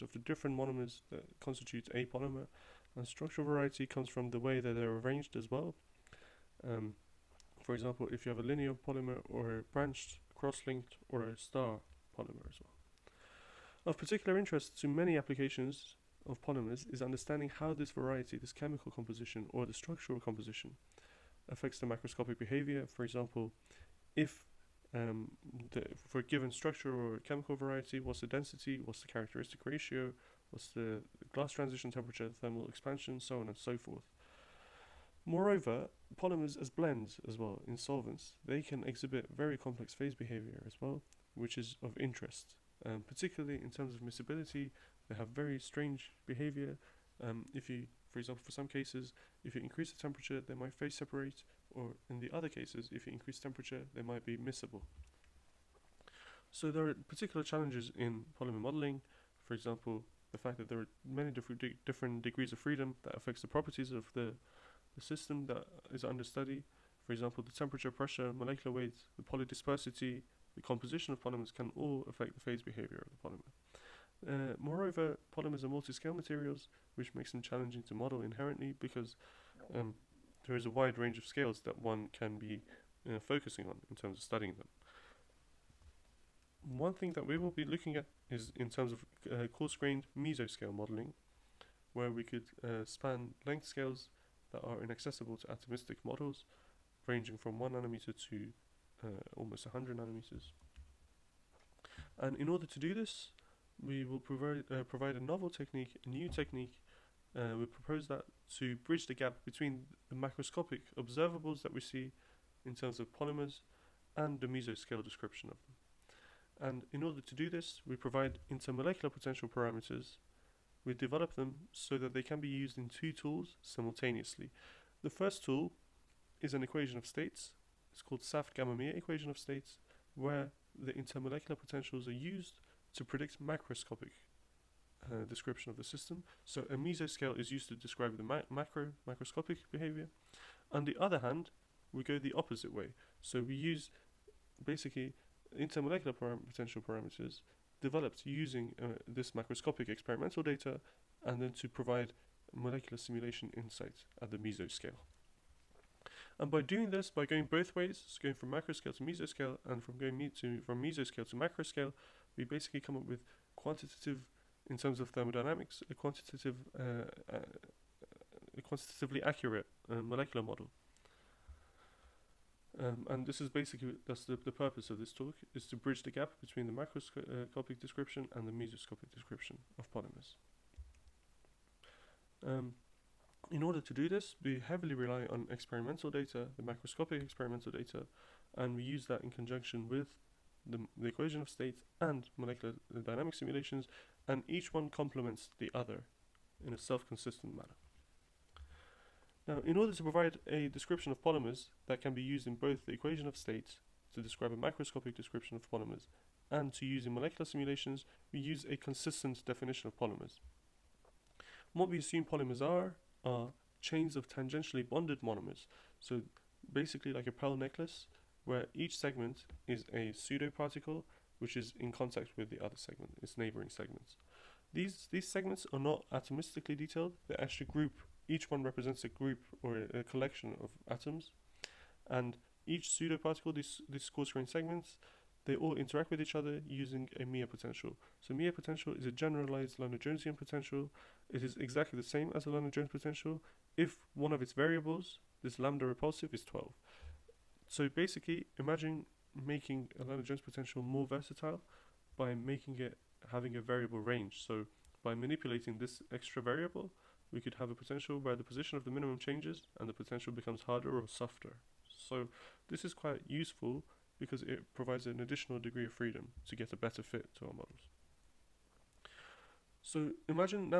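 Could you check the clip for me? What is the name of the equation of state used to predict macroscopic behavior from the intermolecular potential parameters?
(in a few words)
SAFT-Gamma-Mie.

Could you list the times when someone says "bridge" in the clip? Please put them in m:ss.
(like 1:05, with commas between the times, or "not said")
1:48, 2:55.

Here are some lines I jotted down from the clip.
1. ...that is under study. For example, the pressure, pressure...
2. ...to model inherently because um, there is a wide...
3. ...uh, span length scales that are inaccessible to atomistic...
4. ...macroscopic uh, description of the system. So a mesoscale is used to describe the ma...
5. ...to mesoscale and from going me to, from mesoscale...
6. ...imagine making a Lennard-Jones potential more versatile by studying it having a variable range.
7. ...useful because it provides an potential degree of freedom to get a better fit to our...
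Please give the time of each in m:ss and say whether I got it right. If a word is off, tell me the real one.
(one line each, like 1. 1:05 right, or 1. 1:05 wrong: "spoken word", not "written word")
1. 1:05 wrong: "temperature", not "pressure"
2. 1:17 right
3. 1:32 right
4. 2:13 right
5. 2:38 right
6. 4:08 wrong: "making", not "studying"
7. 4:23 wrong: "additional", not "potential".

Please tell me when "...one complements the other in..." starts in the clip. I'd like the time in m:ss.
3:14.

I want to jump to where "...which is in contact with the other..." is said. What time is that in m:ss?
3:41.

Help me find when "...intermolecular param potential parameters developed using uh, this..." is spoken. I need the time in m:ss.
2:25.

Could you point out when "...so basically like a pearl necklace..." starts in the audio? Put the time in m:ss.
3:35.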